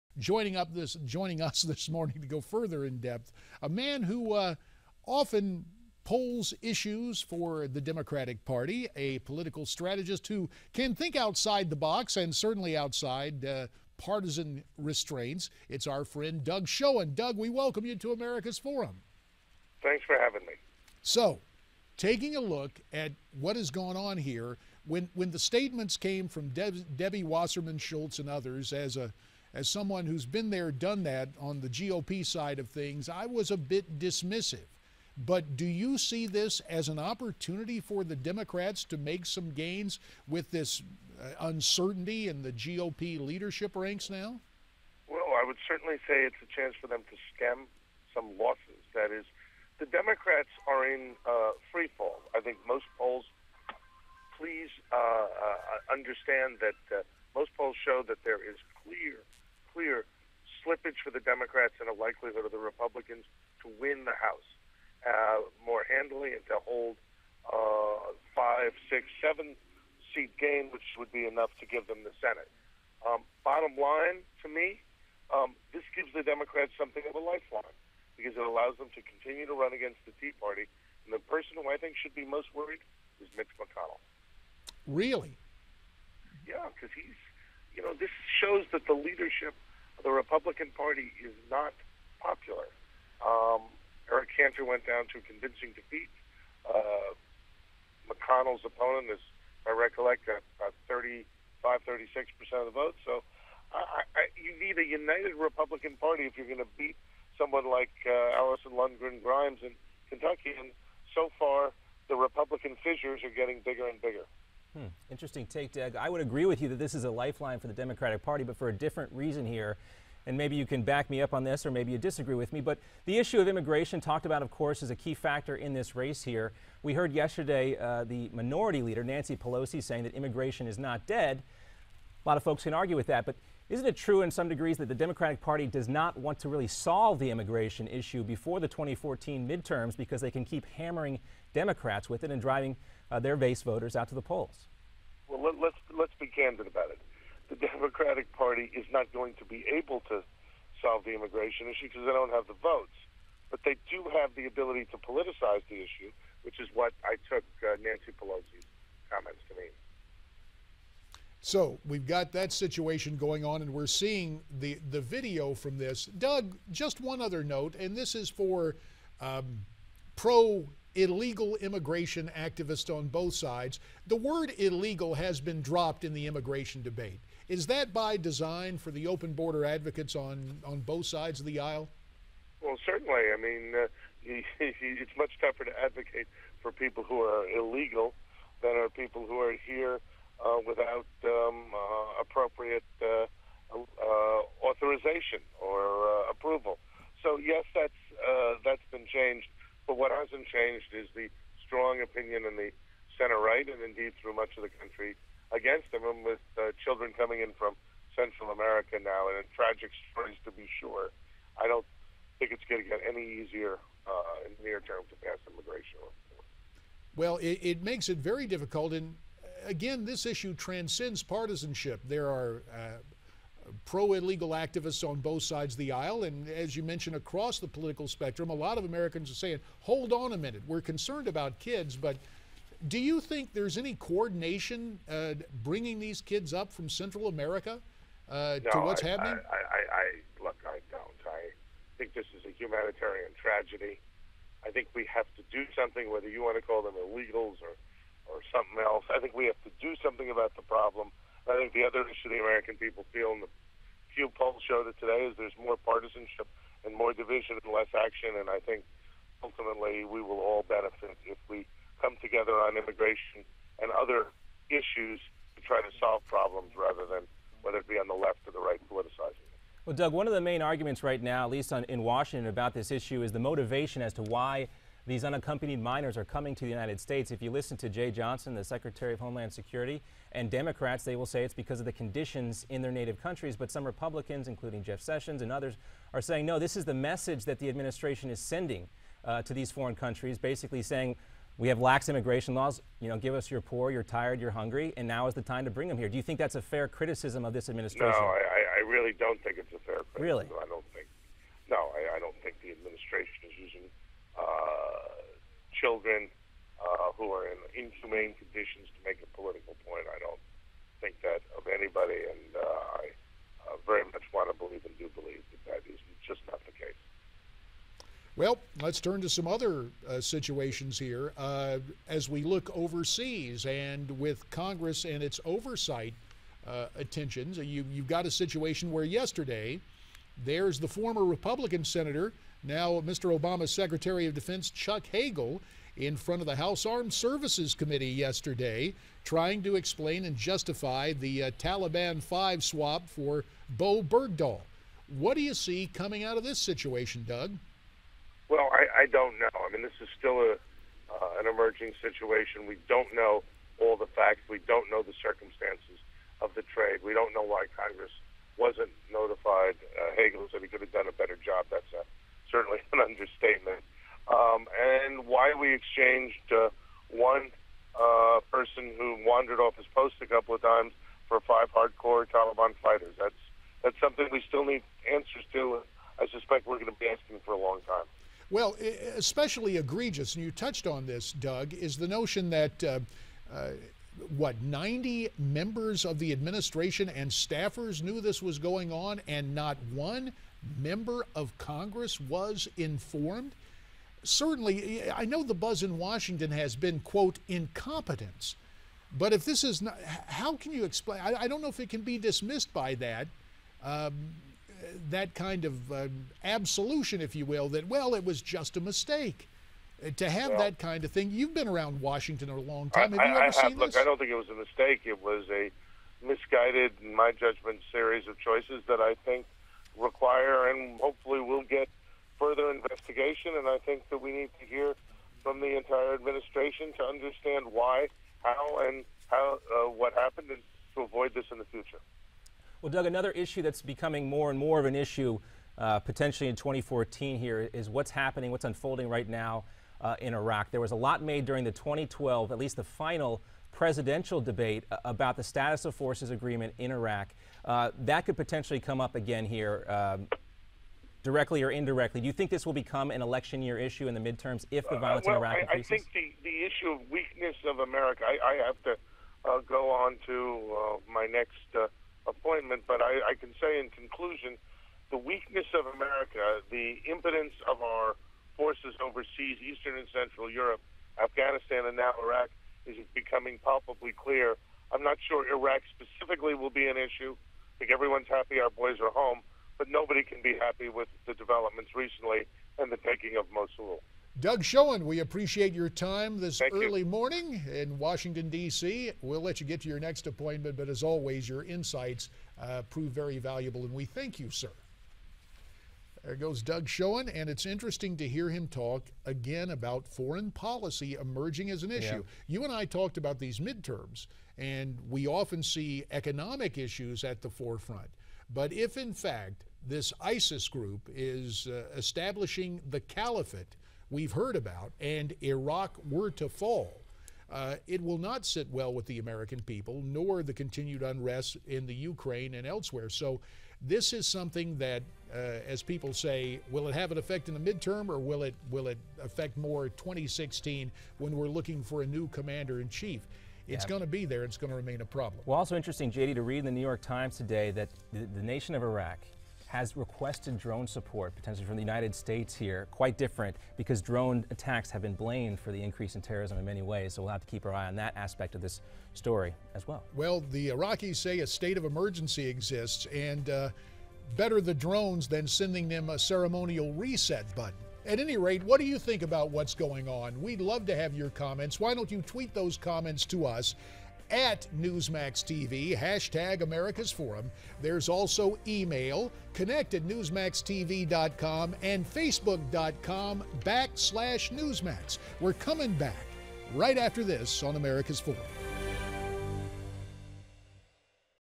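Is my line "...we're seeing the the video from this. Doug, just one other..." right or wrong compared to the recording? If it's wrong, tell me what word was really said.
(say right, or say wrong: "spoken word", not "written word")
right.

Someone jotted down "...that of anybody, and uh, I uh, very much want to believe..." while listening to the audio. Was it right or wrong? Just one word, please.
right.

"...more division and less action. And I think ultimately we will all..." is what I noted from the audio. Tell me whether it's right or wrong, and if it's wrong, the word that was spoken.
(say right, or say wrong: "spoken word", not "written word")
right.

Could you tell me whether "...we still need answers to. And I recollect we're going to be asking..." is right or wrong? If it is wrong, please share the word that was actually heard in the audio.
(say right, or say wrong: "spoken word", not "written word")
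wrong: "suspect", not "recollect".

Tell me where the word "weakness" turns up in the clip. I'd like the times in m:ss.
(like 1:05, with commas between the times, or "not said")
7:37, 7:45.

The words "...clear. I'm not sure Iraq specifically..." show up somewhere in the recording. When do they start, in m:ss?
7:54.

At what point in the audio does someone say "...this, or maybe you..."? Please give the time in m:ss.
2:01.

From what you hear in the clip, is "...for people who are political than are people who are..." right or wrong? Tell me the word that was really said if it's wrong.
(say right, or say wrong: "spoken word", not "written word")
wrong: "illegal", not "political".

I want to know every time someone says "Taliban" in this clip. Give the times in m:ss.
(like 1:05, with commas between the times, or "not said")
5:41, 6:12.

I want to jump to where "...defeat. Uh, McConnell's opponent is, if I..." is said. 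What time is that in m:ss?
1:35.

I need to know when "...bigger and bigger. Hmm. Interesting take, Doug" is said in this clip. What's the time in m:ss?
1:53.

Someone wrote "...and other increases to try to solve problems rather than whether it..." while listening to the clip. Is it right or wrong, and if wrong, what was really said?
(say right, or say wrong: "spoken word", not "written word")
wrong: "issues", not "increases".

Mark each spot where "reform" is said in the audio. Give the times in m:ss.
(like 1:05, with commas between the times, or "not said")
3:35.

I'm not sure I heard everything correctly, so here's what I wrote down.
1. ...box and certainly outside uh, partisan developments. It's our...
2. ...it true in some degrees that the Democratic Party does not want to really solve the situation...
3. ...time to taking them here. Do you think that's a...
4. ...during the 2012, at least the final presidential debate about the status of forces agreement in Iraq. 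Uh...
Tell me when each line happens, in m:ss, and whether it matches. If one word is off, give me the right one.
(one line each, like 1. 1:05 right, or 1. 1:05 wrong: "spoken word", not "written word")
1. 0:11 wrong: "restraints", not "developments"
2. 2:13 wrong: "immigration", not "situation"
3. 4:55 wrong: "bring", not "taking"
4. 7:21 right.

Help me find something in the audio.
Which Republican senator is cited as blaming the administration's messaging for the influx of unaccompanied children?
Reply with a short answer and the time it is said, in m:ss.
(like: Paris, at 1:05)
Jeff Sessions, at 4:44.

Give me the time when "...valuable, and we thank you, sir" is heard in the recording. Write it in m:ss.
8:13.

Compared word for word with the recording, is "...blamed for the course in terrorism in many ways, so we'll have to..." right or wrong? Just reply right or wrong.
wrong.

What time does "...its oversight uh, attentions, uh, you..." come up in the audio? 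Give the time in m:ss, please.
5:25.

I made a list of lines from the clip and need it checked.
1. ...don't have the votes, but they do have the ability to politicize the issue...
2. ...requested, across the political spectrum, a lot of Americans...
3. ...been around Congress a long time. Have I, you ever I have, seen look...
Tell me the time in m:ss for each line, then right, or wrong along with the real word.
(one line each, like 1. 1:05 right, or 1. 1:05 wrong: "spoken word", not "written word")
1. 2:32 right
2. 3:46 wrong: "mentioned", not "requested"
3. 6:51 wrong: "Washington", not "Congress".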